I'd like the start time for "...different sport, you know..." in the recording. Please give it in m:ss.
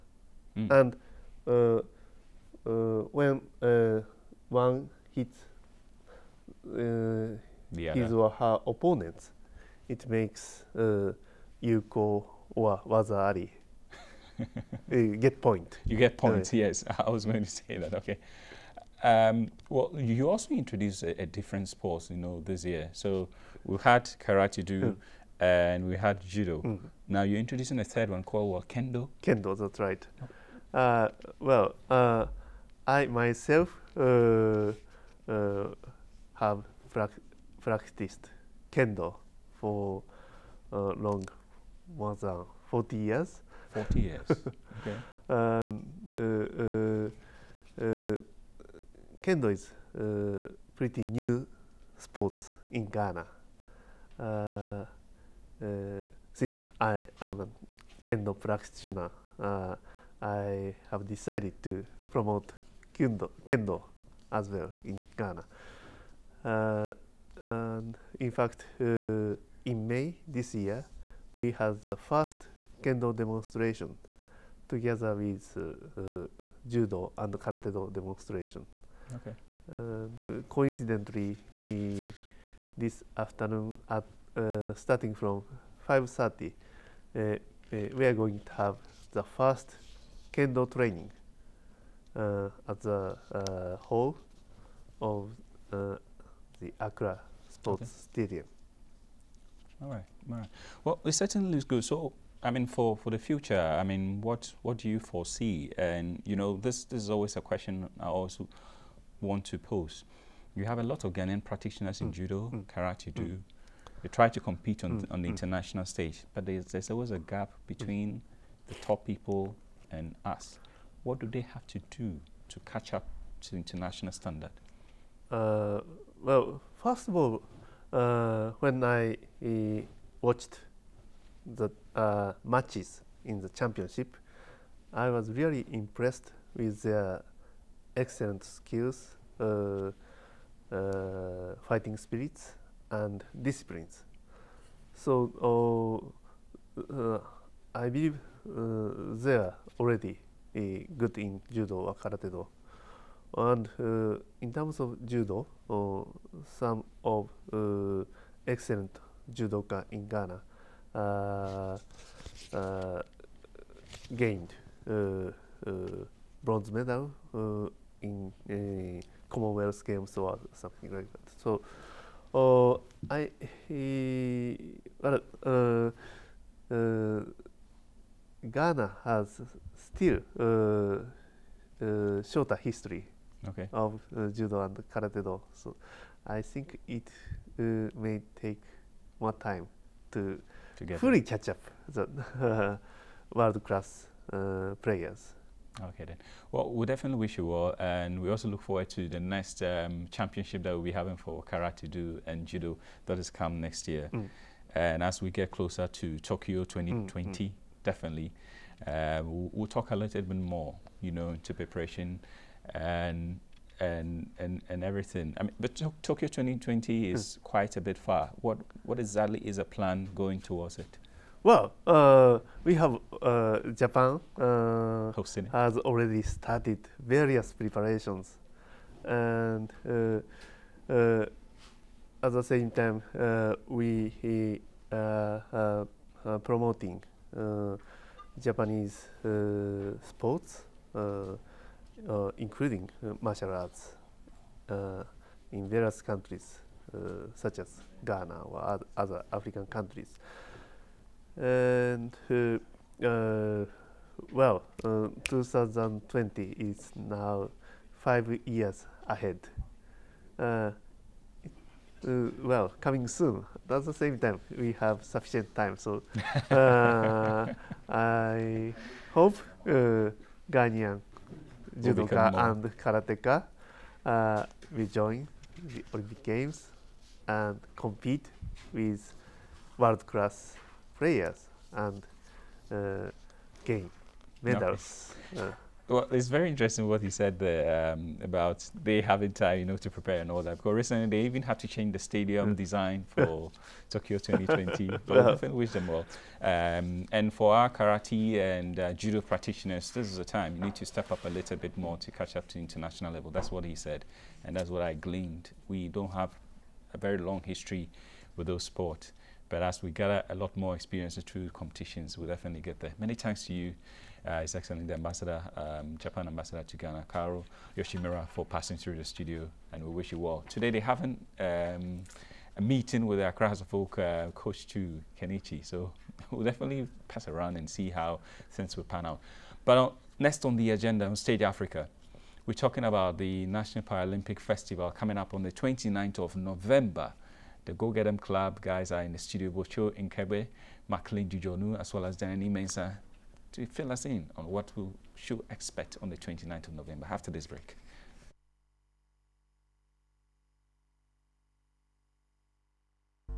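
0:21.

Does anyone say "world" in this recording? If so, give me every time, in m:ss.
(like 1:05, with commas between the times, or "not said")
3:13, 4:39.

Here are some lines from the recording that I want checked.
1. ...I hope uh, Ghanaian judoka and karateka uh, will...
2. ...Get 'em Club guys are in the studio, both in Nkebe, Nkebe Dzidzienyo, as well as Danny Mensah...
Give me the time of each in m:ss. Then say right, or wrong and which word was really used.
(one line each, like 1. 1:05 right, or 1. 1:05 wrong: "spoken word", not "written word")
1. 4:27 right
2. 5:37 wrong: "Maclean", not "Nkebe".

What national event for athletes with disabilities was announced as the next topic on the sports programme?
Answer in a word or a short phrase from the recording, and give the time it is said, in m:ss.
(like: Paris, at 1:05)
National Paralympic Festival, at 5:33.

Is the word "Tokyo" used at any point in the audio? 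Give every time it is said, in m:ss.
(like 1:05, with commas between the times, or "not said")
3:26, 3:36, 4:53.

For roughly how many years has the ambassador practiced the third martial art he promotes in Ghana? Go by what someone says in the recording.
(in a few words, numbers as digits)
more than 40 years.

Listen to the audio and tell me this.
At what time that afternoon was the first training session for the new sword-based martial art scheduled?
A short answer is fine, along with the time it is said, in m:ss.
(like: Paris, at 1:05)
5.30, at 1:25.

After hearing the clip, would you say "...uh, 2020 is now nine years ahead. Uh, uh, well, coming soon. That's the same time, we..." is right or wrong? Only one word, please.
wrong.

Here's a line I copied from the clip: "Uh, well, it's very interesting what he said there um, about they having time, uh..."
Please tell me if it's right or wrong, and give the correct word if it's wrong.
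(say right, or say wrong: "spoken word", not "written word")
right.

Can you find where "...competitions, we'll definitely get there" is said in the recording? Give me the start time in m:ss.
5:11.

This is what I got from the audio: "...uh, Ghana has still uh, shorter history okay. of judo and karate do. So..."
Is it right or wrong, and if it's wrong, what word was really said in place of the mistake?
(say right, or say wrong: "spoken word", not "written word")
right.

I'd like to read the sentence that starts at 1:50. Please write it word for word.
You have a lot of Ghanaian practitioners in mm.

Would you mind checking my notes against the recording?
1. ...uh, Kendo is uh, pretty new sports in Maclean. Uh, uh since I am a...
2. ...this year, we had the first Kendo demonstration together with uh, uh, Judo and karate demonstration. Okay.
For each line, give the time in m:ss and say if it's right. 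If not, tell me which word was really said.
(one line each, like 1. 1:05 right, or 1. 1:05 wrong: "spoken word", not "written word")
1. 0:47 wrong: "Ghana", not "Maclean"
2. 1:10 right.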